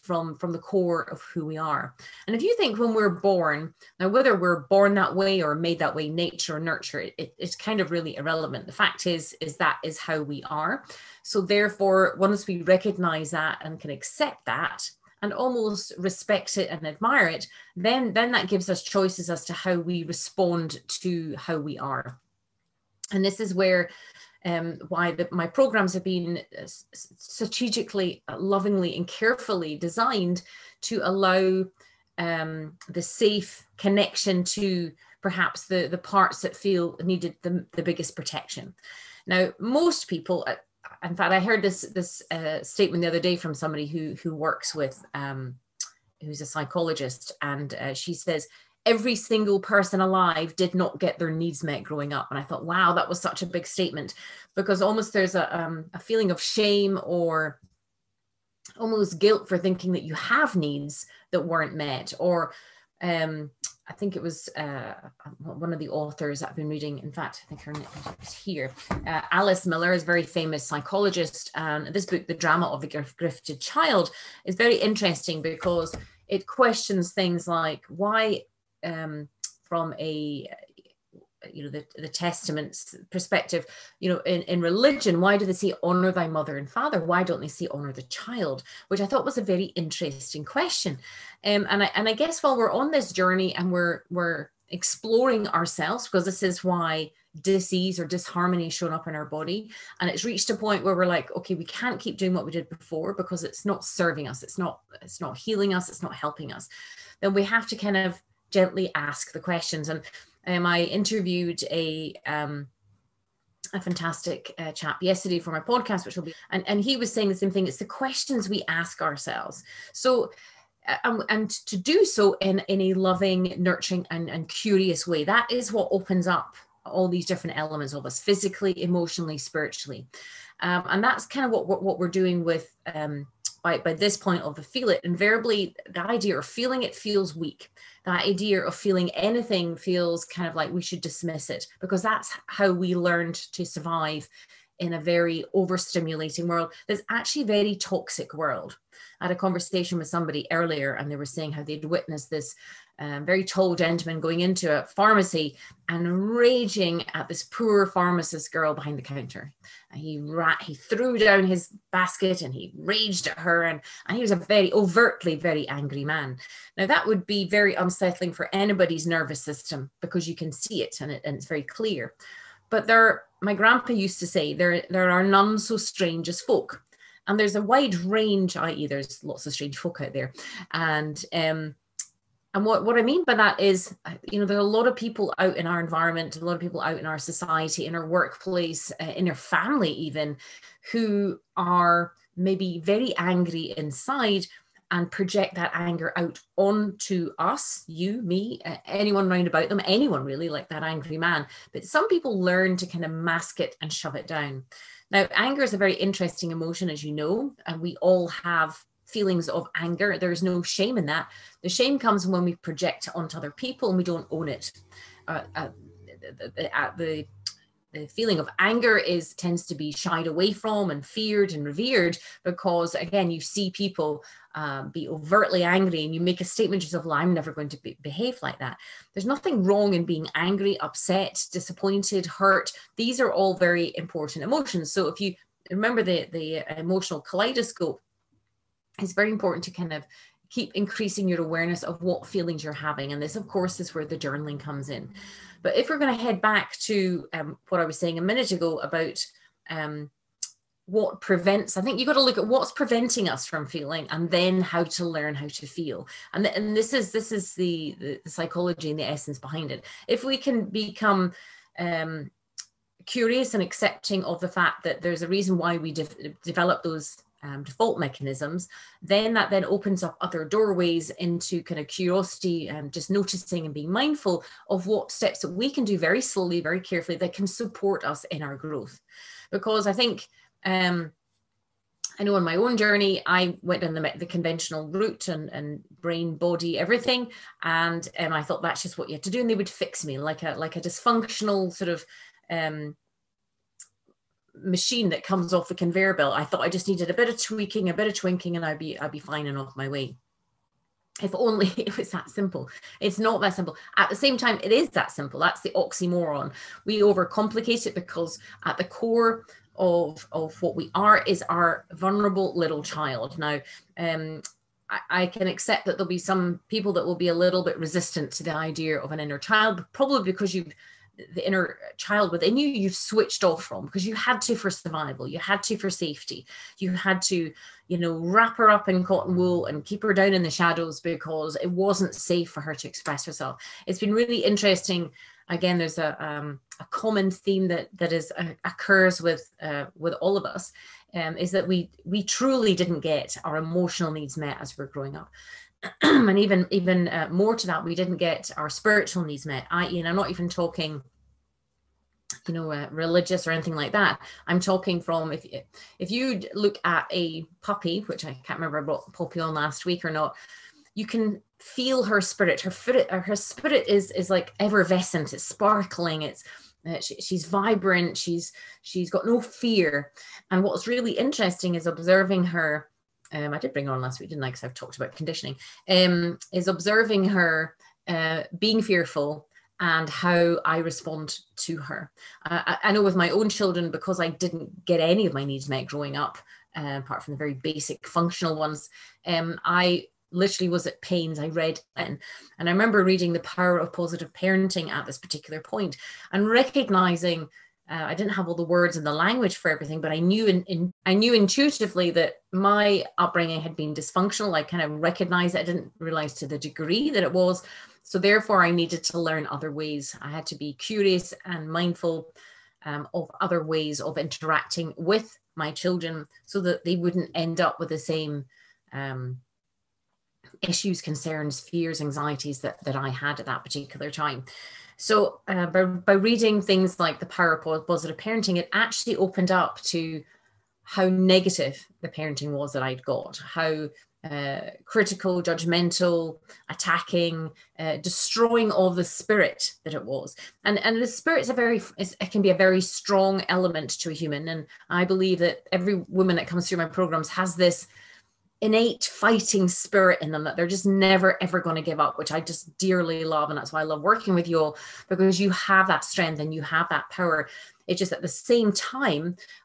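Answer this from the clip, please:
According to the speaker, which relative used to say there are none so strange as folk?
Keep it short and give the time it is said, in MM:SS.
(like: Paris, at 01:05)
Grandpa, at 02:53.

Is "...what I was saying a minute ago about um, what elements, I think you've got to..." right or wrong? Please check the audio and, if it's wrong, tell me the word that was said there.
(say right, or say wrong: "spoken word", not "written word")
wrong: "prevents", not "elements".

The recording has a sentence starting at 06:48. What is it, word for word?
So therefore, I needed to learn other ways.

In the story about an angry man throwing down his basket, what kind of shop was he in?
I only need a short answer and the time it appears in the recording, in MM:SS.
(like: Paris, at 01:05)
Pharmacy, at 02:34.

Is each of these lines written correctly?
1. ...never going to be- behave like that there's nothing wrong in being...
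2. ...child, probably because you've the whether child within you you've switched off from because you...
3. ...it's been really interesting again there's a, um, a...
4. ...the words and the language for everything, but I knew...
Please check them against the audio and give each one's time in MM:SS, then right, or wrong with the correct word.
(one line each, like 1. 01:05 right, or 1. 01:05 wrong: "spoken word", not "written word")
1. 03:47 right
2. 05:19 wrong: "inner", not "whether"
3. 05:33 right
4. 06:38 right.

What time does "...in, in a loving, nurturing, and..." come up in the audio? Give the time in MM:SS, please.
02:02.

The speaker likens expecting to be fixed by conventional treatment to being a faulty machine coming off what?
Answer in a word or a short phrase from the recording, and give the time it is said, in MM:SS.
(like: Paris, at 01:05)
Conveyor belt, at 04:55.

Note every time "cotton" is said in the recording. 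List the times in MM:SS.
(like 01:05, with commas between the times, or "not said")
05:29.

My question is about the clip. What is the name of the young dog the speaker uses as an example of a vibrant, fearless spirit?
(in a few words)
Poppy.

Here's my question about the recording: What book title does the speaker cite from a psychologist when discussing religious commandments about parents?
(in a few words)
The Drama of a Gifted Child.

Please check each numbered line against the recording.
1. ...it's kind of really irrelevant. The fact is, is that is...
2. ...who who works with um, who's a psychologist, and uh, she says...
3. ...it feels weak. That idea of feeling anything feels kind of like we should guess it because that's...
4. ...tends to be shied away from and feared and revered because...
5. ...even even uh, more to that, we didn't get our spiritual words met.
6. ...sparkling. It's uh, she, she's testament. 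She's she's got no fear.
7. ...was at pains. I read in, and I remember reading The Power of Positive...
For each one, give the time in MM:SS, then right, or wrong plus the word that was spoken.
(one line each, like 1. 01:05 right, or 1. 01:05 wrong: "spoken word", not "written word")
1. 00:07 right
2. 00:43 right
3. 02:16 wrong: "dismiss", not "guess"
4. 03:39 right
5. 05:46 wrong: "needs", not "words"
6. 06:05 wrong: "vibrant", not "testament"
7. 06:30 right.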